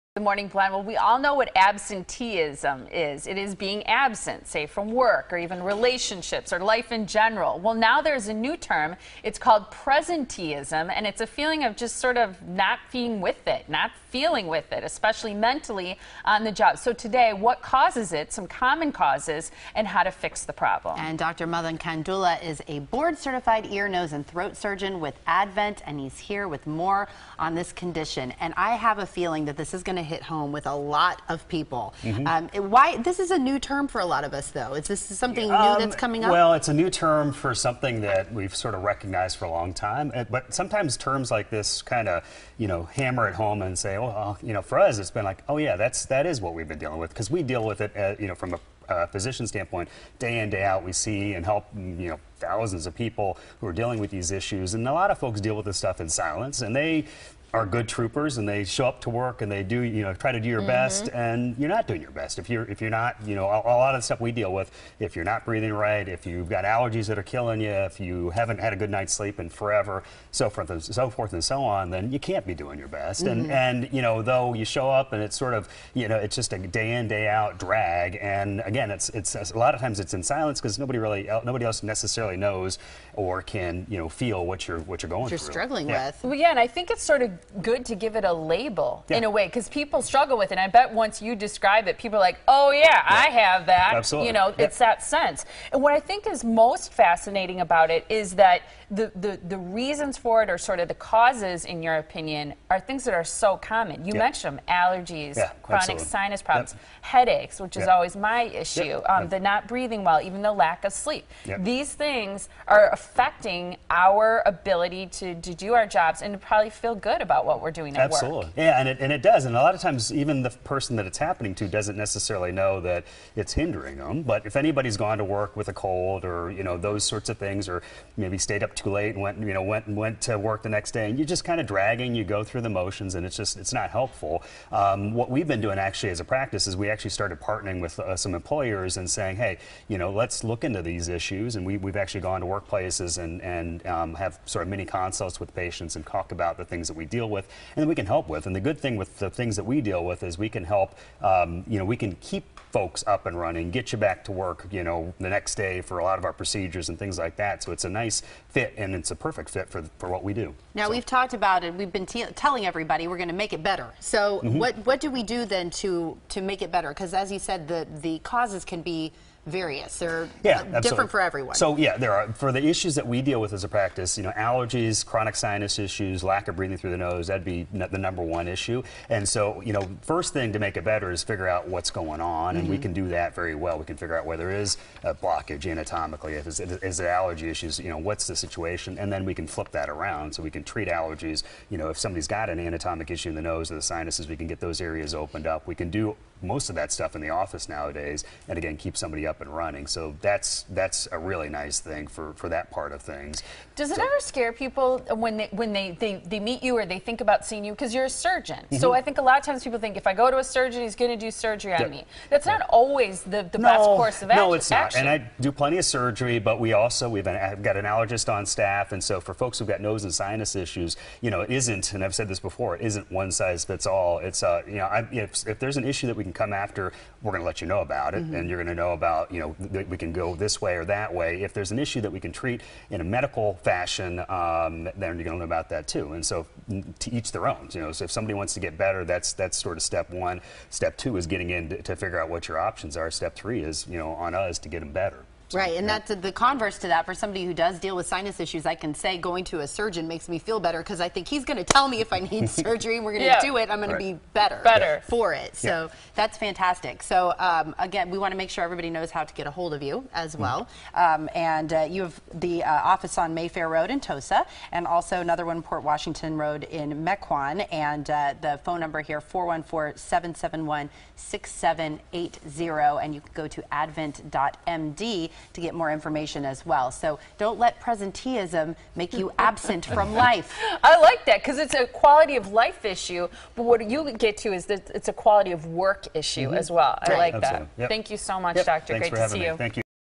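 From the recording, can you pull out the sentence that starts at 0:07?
Well, now there's a new term.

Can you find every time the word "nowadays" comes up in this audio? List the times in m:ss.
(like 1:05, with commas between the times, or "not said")
3:17.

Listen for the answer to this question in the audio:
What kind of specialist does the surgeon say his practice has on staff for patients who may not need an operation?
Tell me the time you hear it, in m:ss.
3:37.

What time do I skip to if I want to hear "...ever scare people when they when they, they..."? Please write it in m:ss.
3:24.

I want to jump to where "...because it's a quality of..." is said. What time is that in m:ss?
4:41.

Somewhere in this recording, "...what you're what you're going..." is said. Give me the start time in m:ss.
1:24.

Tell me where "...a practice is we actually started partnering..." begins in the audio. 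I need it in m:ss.
2:16.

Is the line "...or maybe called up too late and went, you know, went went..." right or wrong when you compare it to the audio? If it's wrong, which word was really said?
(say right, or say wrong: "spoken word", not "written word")
wrong: "stayed", not "called".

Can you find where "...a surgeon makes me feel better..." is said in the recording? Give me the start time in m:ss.
4:09.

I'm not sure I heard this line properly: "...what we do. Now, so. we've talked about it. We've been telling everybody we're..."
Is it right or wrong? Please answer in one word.
right.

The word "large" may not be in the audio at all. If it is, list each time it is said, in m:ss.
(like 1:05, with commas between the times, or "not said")
not said.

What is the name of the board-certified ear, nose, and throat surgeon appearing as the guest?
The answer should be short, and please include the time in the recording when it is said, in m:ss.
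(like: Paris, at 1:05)
Madan Kandula, at 0:21.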